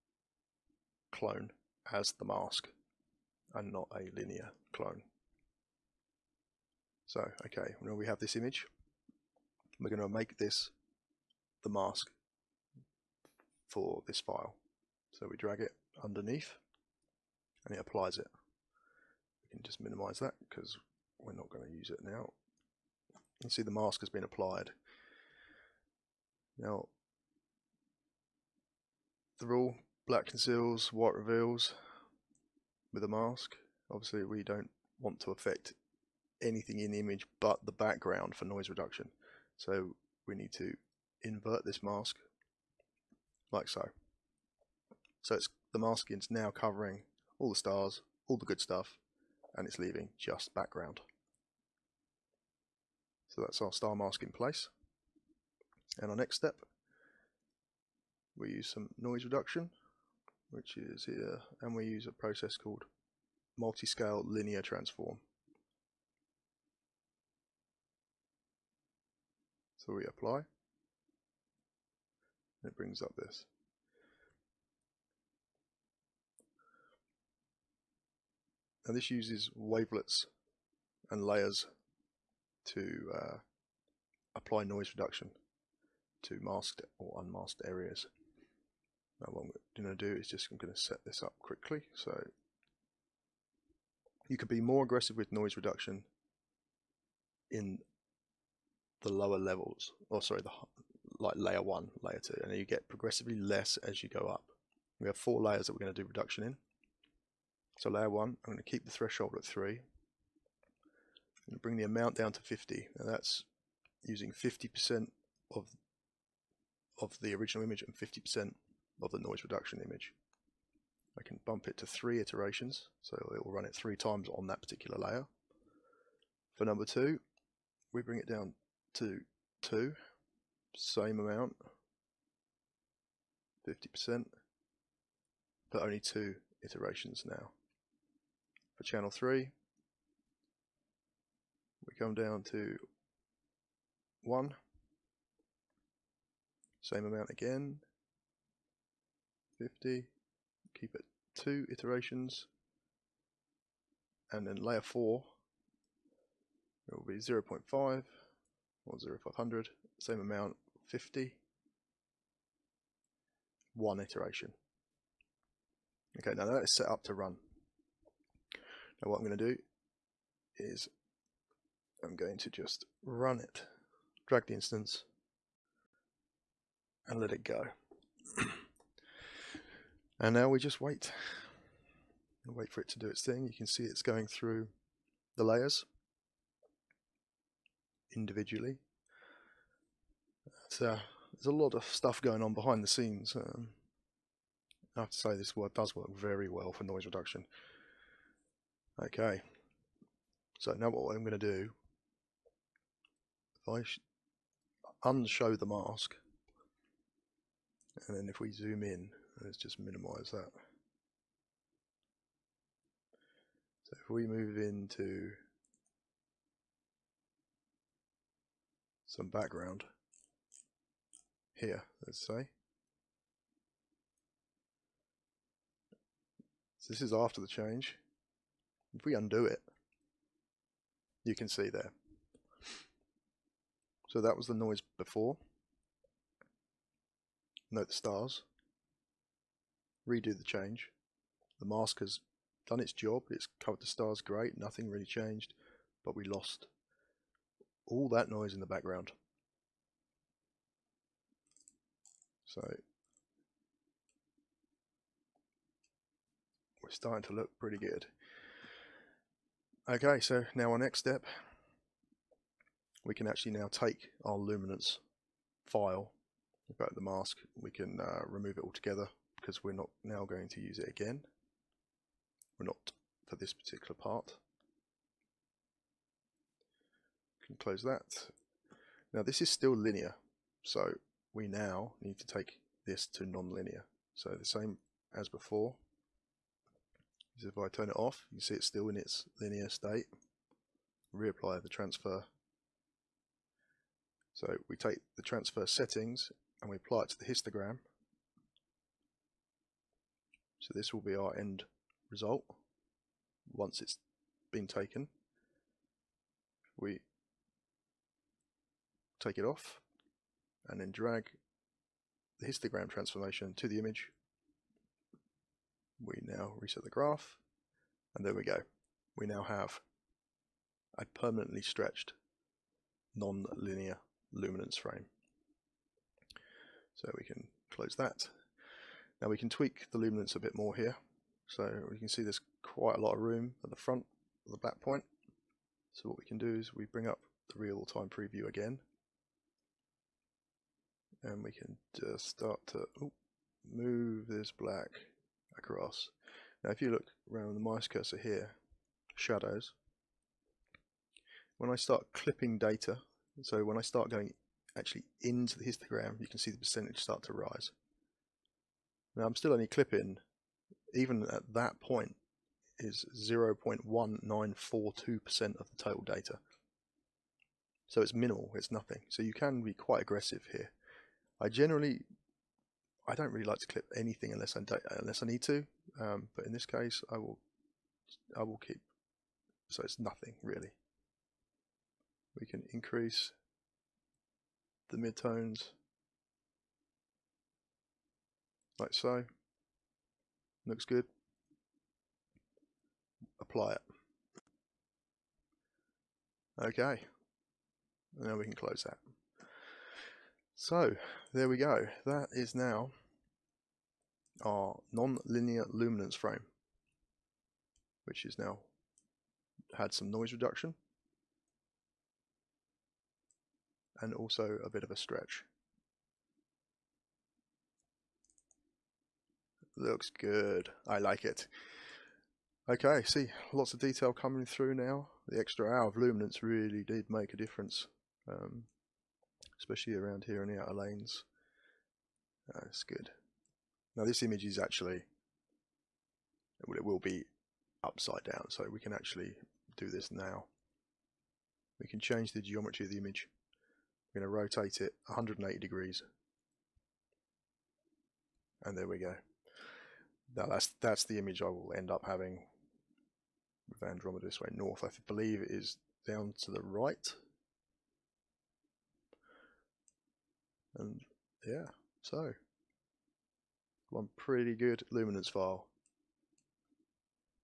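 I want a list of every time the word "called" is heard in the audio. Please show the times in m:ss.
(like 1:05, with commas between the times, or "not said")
1:02.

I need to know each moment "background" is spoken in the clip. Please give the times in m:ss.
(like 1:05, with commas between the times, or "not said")
0:37, 0:50, 3:39, 4:08.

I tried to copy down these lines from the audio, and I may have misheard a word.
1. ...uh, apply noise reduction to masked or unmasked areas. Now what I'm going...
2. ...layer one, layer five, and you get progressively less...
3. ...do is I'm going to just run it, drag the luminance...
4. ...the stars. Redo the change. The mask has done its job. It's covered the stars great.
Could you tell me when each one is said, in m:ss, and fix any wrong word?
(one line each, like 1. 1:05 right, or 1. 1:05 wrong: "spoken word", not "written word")
1. 1:23 right
2. 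1:41 wrong: "two", not "five"
3. 2:49 wrong: "instance", not "luminance"
4. 3:57 right.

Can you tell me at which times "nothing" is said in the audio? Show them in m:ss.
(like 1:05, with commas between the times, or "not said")
4:04, 6:08, 6:19.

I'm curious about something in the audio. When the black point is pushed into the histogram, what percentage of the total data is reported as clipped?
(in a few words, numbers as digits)
0.1942%.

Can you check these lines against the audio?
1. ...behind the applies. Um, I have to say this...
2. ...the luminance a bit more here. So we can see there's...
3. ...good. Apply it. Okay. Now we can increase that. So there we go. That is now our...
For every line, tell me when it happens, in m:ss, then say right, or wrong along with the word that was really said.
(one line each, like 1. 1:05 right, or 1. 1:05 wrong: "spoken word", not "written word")
1. 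3:12 wrong: "scenes", not "applies"
2. 5:29 right
3. 6:30 wrong: "close", not "increase".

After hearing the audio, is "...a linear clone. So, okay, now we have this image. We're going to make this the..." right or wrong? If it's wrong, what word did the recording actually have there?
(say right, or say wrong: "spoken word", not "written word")
right.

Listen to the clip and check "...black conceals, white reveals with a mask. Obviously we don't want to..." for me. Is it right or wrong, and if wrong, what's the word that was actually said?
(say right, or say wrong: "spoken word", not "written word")
right.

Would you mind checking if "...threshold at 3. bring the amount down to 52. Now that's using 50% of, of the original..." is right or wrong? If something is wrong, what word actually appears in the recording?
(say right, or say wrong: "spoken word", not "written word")
wrong: "50", not "52".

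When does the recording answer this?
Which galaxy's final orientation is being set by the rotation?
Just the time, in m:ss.
7:33.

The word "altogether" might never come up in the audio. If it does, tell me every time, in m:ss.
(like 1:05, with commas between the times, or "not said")
4:28.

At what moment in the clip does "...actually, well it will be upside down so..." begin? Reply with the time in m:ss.
7:14.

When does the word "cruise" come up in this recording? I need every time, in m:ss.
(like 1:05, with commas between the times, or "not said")
not said.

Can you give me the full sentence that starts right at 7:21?
We can change the geometry of the image.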